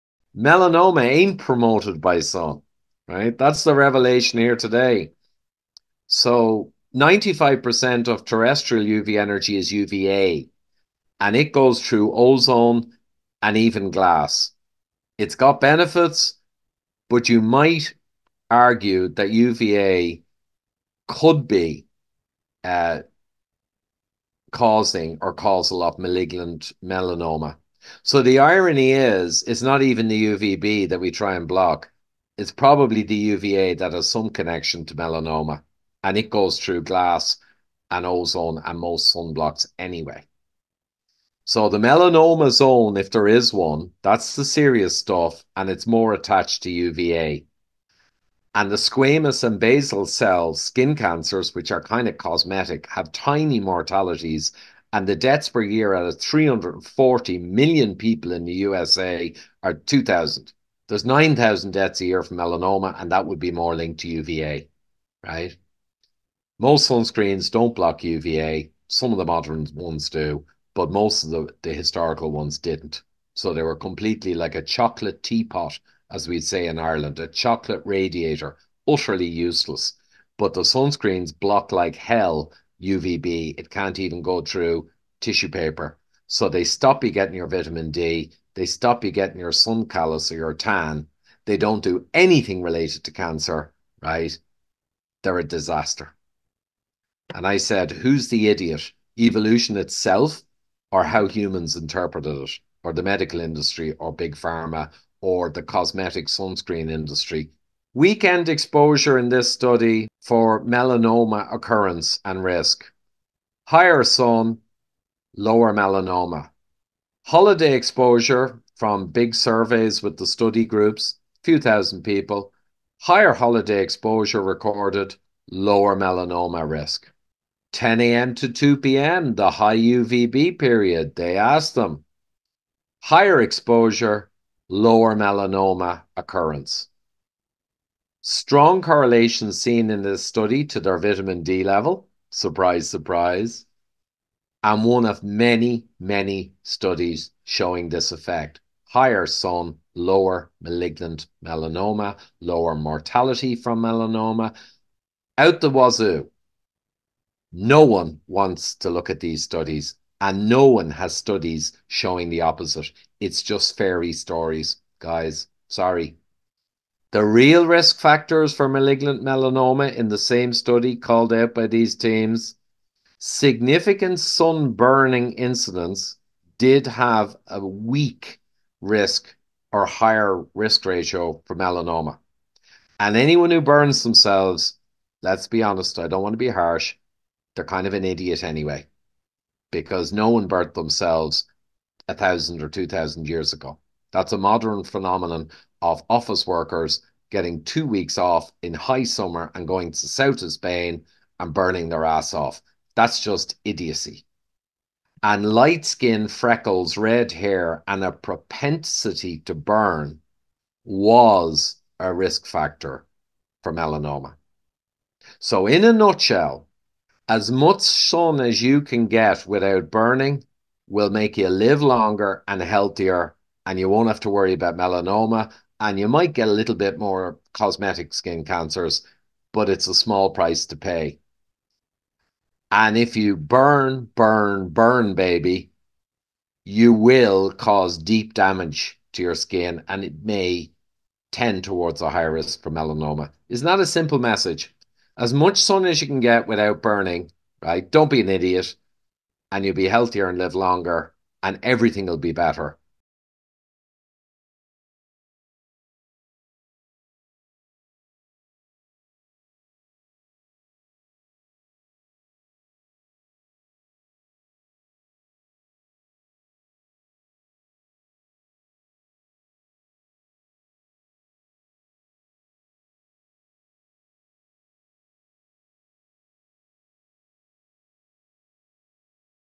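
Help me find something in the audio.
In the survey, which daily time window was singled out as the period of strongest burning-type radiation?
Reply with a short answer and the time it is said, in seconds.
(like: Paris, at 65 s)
10 a.m. to 2 p.m., at 127 s.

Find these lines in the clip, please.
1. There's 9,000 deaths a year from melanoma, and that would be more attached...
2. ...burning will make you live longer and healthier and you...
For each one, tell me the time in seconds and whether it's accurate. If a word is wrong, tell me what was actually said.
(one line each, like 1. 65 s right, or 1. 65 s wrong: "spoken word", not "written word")
1. 60 s wrong: "linked", not "attached"
2. 219 s right.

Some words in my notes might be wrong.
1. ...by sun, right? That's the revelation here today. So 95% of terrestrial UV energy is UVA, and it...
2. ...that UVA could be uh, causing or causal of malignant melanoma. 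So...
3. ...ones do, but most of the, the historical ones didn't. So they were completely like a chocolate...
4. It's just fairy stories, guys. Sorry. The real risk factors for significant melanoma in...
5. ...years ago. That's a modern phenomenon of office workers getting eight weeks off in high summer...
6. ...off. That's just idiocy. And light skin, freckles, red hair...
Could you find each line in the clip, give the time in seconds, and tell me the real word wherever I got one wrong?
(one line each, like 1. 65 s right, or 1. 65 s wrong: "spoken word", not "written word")
1. 2 s right
2. 19 s right
3. 69 s right
4. 163 s wrong: "malignant", not "significant"
5. 193 s wrong: "two", not "eight"
6. 202 s right.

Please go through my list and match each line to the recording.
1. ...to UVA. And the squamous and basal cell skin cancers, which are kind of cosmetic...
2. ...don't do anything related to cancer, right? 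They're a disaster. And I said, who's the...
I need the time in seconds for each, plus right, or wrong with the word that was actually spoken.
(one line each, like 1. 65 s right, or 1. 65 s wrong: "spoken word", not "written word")
1. 46 s right
2. 91 s right.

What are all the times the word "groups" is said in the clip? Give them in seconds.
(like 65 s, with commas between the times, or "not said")
120 s.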